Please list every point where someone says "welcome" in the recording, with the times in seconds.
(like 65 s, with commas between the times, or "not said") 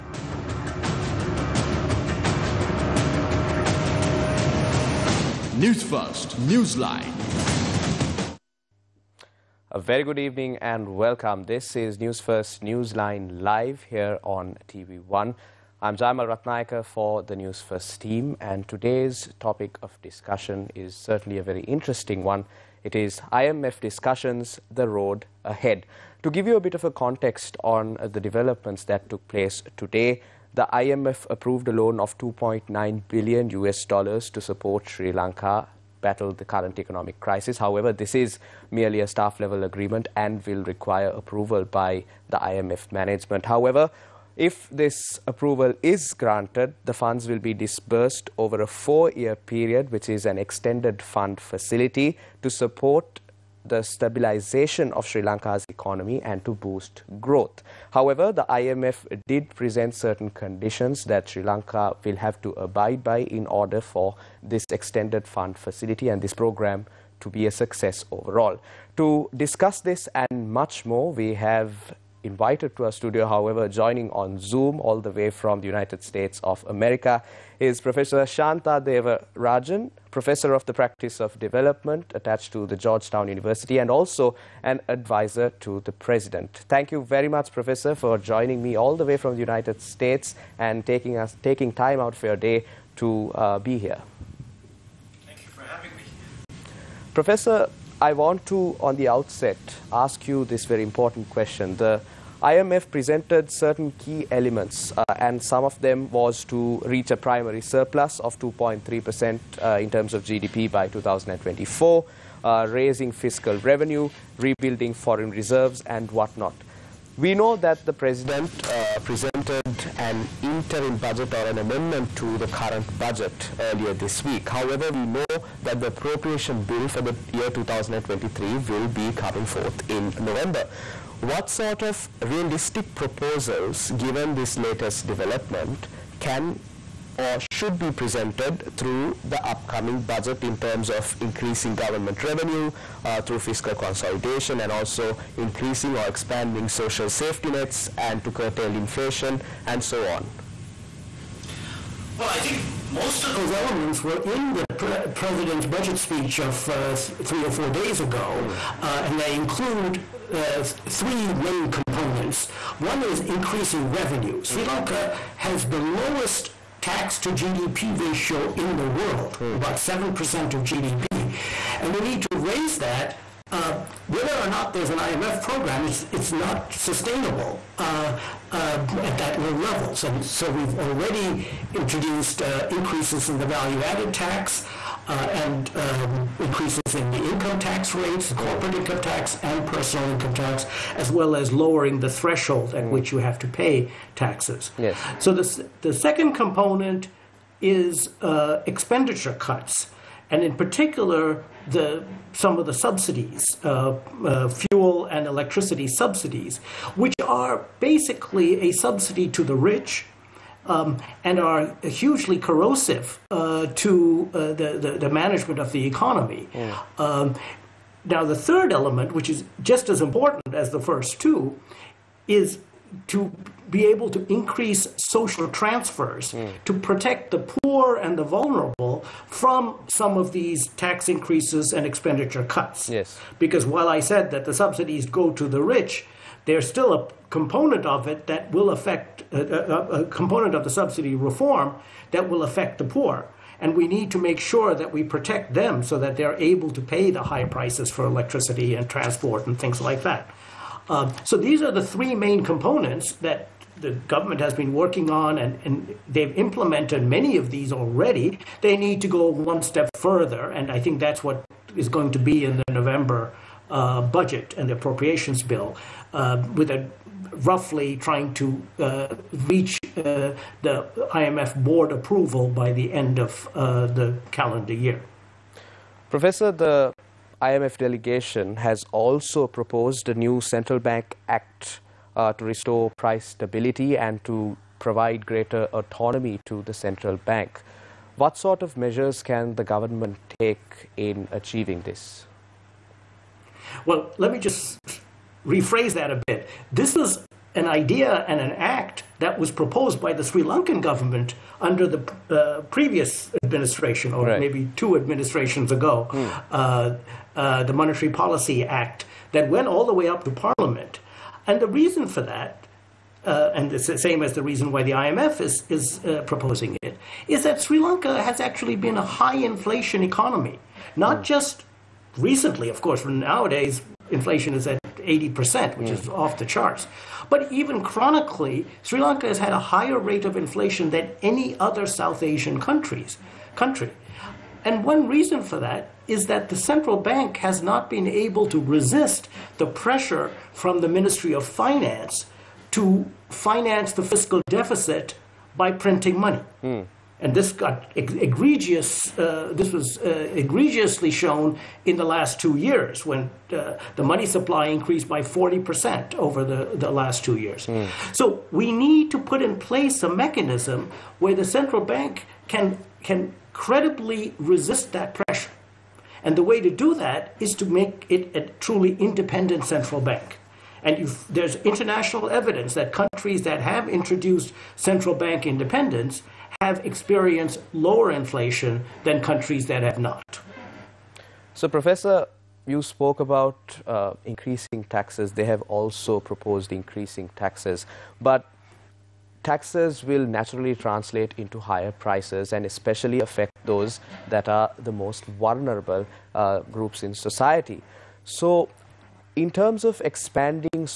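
10 s.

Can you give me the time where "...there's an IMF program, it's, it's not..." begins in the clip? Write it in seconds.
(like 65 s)
174 s.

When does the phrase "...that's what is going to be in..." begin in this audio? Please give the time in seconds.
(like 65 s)
260 s.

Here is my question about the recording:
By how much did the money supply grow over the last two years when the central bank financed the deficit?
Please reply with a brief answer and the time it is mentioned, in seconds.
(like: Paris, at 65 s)
40%, at 355 s.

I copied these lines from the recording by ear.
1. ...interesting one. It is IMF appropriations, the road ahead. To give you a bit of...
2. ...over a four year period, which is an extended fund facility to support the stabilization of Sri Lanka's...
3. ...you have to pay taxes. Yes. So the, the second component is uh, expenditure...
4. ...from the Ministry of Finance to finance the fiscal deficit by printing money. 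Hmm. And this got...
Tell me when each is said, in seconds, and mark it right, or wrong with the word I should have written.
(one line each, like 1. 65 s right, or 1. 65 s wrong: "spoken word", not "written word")
1. 21 s wrong: "discussions", not "appropriations"
2. 48 s right
3. 193 s right
4. 340 s right.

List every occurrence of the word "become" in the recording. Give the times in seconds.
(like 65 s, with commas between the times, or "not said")
not said.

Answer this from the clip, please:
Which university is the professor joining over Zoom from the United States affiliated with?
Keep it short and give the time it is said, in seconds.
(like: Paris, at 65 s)
Georgetown University, at 82 s.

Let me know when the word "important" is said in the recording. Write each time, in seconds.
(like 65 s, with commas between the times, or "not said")
100 s, 220 s.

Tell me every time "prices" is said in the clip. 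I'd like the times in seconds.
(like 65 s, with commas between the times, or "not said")
247 s, 283 s, 391 s.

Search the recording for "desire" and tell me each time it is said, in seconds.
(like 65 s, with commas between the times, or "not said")
not said.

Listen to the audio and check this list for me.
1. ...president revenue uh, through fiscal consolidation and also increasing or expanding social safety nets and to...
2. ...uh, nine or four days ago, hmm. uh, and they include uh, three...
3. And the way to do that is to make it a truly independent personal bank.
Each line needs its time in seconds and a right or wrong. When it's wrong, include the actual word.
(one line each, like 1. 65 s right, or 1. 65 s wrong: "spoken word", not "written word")
1. 141 s wrong: "government", not "president"
2. 156 s wrong: "three", not "nine"
3. 366 s wrong: "central", not "personal".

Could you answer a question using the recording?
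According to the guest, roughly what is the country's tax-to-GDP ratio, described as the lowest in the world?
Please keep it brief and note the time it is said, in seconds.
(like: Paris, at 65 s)
7%, at 169 s.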